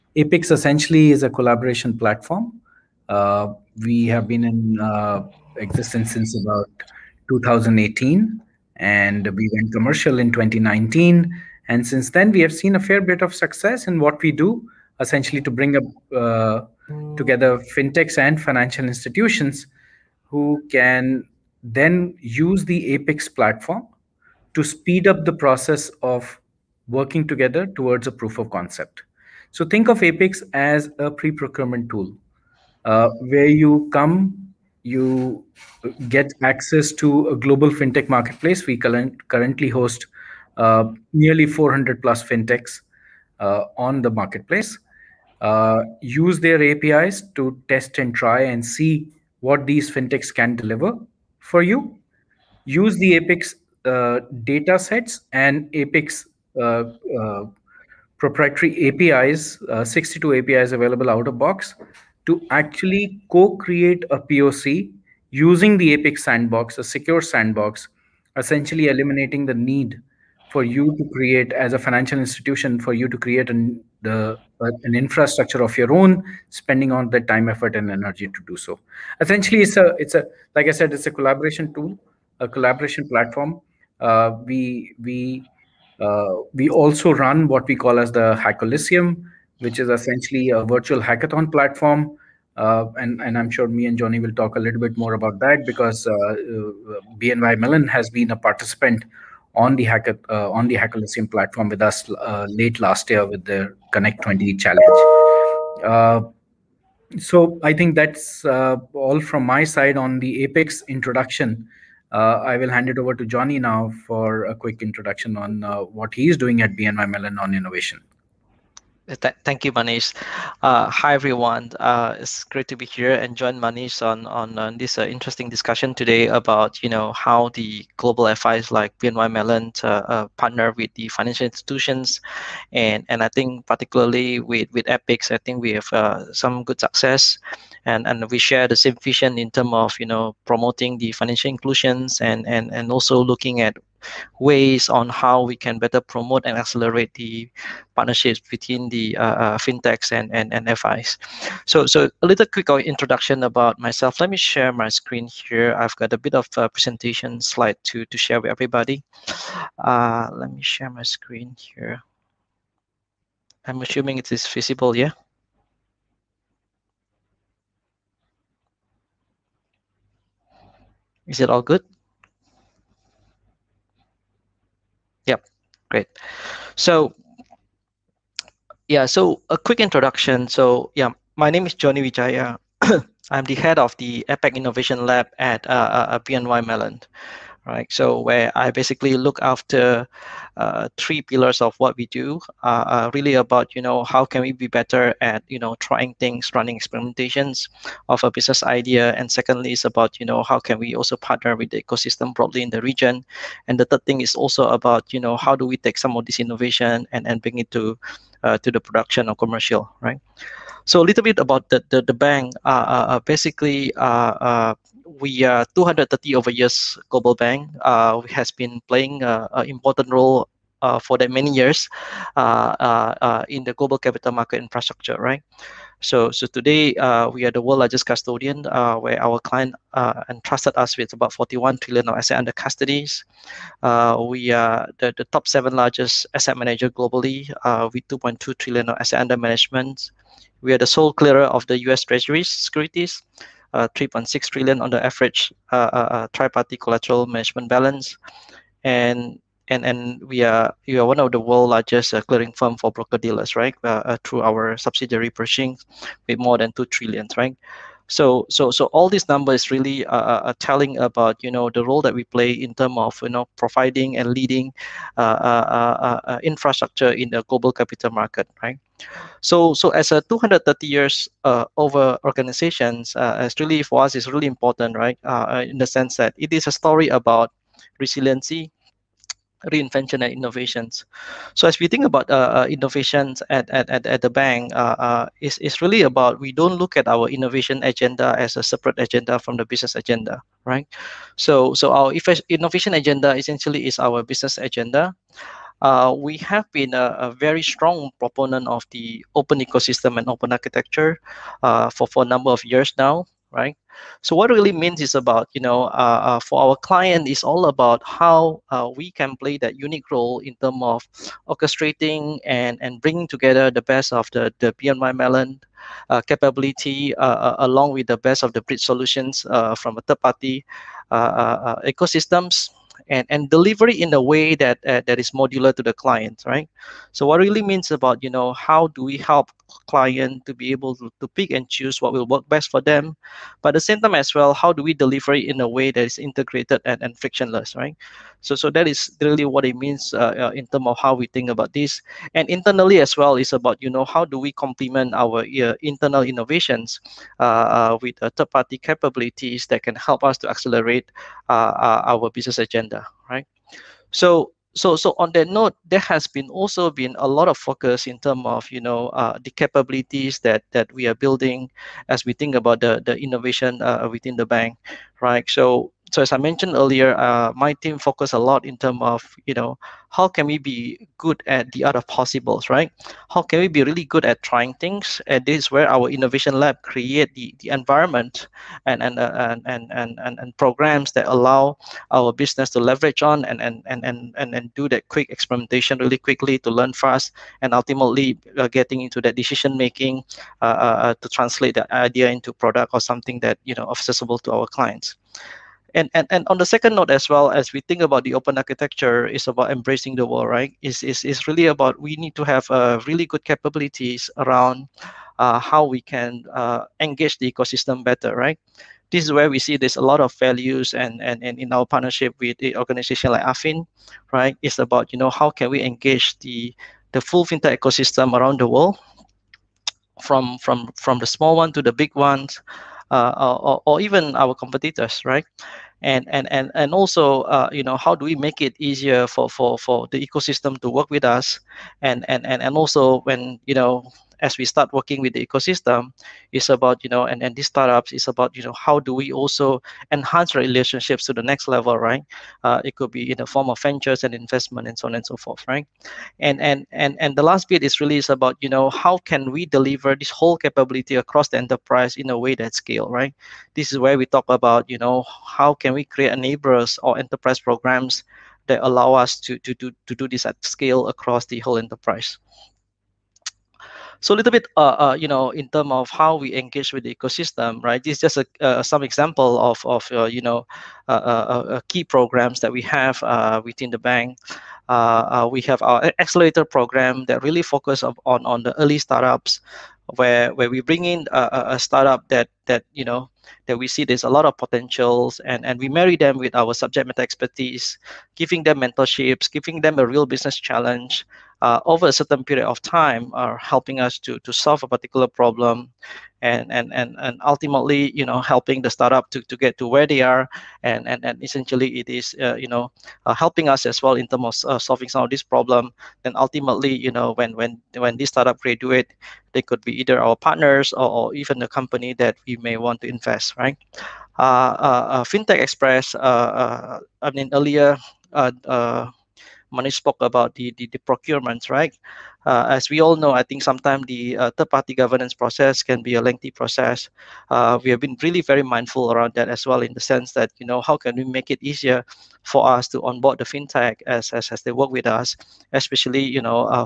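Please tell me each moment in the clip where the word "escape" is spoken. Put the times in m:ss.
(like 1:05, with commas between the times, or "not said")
not said.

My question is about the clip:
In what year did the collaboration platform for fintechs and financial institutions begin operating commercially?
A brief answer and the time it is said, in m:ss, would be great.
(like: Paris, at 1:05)
2019, at 0:10.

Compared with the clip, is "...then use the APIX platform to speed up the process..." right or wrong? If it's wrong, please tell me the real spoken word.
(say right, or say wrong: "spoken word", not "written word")
right.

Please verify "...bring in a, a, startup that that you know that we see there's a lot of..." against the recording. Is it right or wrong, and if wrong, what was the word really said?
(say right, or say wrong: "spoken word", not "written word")
right.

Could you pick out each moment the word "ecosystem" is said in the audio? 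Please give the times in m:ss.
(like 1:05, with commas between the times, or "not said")
3:21, 4:59, 5:21, 6:47, 6:57, 7:10, 7:15, 7:47.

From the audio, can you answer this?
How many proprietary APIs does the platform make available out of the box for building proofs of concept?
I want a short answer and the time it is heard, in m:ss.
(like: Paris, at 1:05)
62, at 0:59.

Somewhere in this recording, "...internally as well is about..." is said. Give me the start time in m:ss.
5:42.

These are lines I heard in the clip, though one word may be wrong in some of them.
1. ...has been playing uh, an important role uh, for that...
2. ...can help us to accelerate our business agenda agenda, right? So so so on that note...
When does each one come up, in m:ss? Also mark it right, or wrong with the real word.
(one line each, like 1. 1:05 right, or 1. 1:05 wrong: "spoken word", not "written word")
1. 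3:38 right
2. 5:49 right.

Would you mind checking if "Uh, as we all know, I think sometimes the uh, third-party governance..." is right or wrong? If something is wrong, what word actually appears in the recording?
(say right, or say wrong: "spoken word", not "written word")
right.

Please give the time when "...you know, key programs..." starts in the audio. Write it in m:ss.
7:50.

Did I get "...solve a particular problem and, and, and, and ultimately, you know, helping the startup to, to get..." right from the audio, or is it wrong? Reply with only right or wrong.
right.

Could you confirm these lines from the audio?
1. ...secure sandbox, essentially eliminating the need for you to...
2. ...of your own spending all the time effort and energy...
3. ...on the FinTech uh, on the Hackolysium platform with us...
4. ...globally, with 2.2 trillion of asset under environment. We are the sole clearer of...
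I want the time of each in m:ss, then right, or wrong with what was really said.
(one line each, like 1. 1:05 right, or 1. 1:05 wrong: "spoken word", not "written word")
1. 1:06 right
2. 1:15 right
3. 1:39 wrong: "Hack", not "FinTech"
4. 3:56 wrong: "management", not "environment".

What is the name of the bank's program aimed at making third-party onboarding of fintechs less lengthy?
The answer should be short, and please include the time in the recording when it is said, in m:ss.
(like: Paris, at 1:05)
FinTech Express, at 8:35.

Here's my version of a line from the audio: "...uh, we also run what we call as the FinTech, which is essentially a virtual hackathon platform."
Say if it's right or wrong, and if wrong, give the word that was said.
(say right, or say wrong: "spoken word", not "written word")
wrong: "Hackolysium", not "FinTech".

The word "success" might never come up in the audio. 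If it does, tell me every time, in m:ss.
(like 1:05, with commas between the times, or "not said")
0:13, 2:16.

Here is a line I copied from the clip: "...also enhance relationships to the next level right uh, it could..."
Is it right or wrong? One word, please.
right.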